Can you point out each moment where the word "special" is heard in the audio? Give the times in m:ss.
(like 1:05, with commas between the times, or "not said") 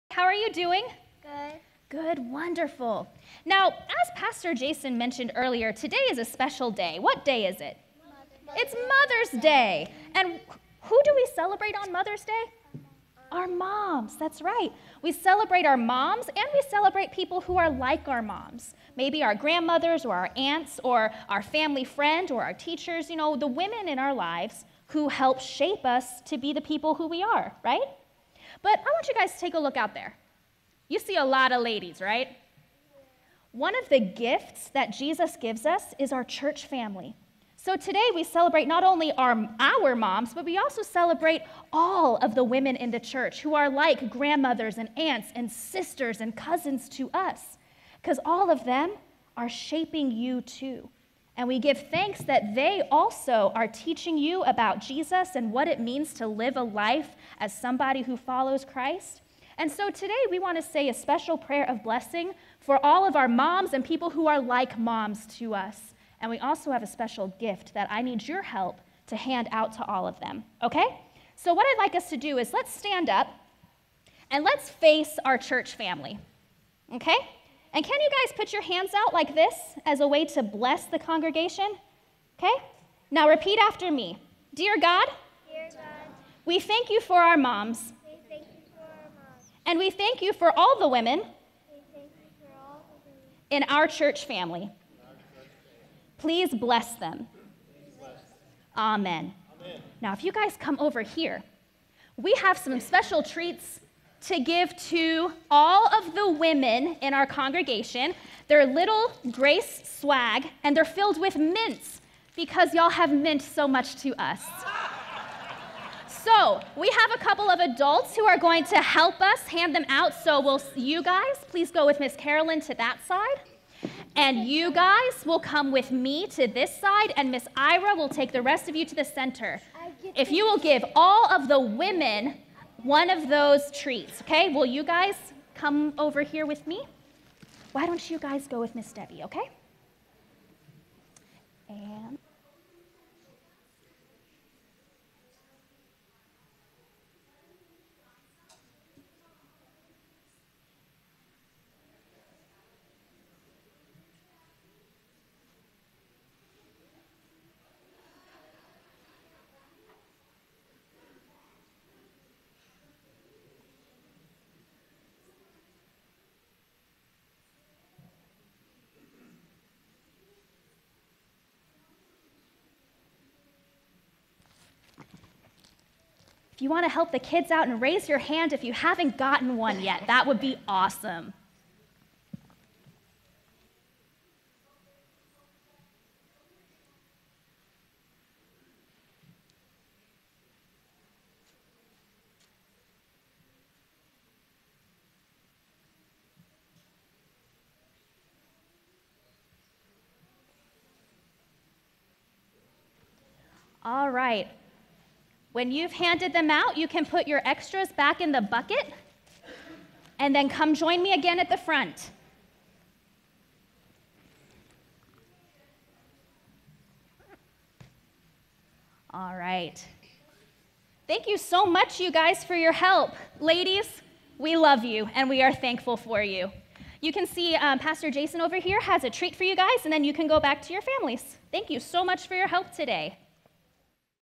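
0:06, 1:00, 1:06, 1:42.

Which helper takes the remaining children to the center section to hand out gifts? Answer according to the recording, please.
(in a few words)
Miss Ira.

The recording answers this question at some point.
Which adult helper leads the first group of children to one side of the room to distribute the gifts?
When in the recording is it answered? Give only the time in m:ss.
2:01.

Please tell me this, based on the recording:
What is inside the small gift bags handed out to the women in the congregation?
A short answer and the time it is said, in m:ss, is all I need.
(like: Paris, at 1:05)
Mints, at 1:51.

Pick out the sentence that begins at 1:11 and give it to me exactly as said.
So, what I'd like us to do is let's stand up and let's face our church family, okay?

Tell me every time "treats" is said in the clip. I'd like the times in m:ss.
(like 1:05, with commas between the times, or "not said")
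1:43, 3:49.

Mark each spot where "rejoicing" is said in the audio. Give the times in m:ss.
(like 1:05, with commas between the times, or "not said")
not said.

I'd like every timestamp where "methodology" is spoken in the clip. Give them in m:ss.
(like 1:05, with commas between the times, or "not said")
not said.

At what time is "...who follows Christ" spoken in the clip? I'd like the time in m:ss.
0:58.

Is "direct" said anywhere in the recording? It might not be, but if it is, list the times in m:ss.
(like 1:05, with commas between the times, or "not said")
not said.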